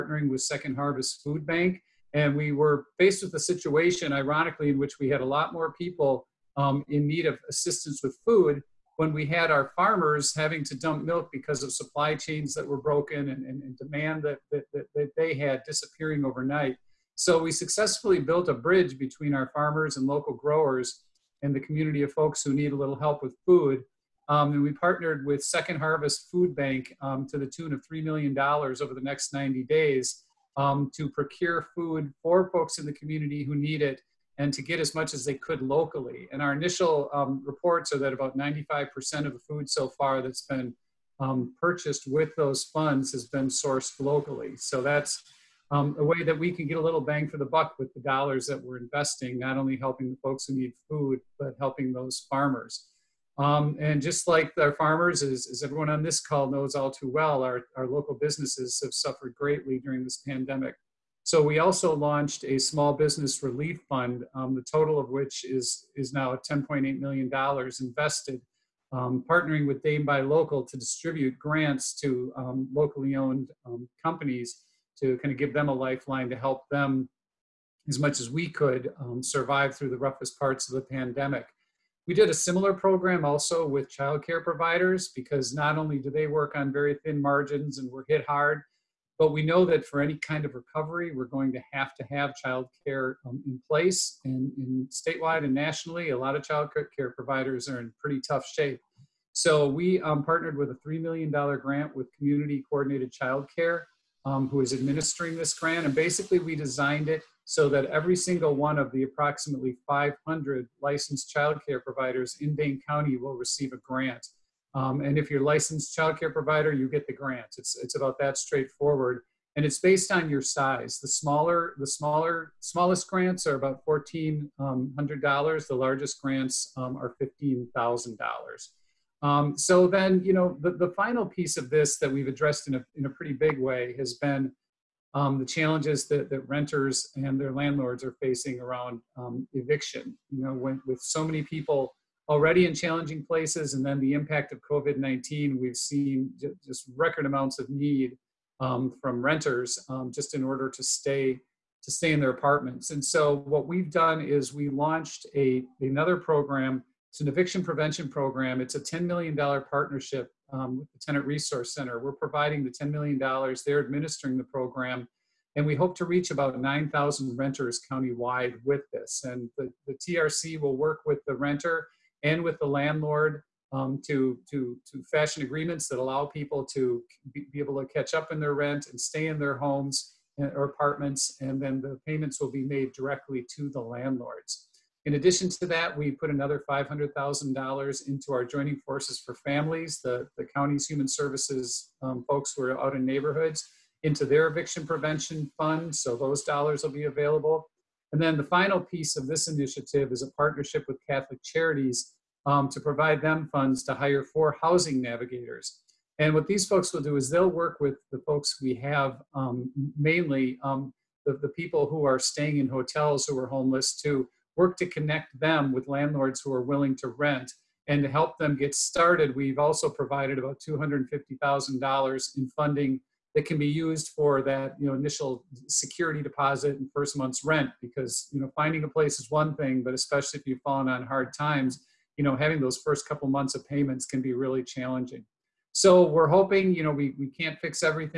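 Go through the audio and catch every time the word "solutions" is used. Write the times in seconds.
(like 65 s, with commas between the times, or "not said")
not said.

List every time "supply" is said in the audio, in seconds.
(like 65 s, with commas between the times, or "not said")
11 s.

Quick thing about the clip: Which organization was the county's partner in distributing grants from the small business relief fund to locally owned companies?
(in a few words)
Dane Buy Local.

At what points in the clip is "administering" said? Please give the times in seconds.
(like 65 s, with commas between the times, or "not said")
104 s, 163 s.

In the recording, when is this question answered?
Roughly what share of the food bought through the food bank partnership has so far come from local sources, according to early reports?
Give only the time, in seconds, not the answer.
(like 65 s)
38 s.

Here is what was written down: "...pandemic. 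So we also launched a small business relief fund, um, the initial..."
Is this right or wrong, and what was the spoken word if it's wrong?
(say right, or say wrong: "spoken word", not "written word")
wrong: "total", not "initial".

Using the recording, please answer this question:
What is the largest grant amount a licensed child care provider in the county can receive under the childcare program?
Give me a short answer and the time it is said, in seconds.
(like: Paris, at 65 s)
$15,000, at 127 s.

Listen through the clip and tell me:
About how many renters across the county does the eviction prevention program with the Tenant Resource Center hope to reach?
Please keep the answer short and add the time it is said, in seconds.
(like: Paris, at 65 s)
9,000, at 166 s.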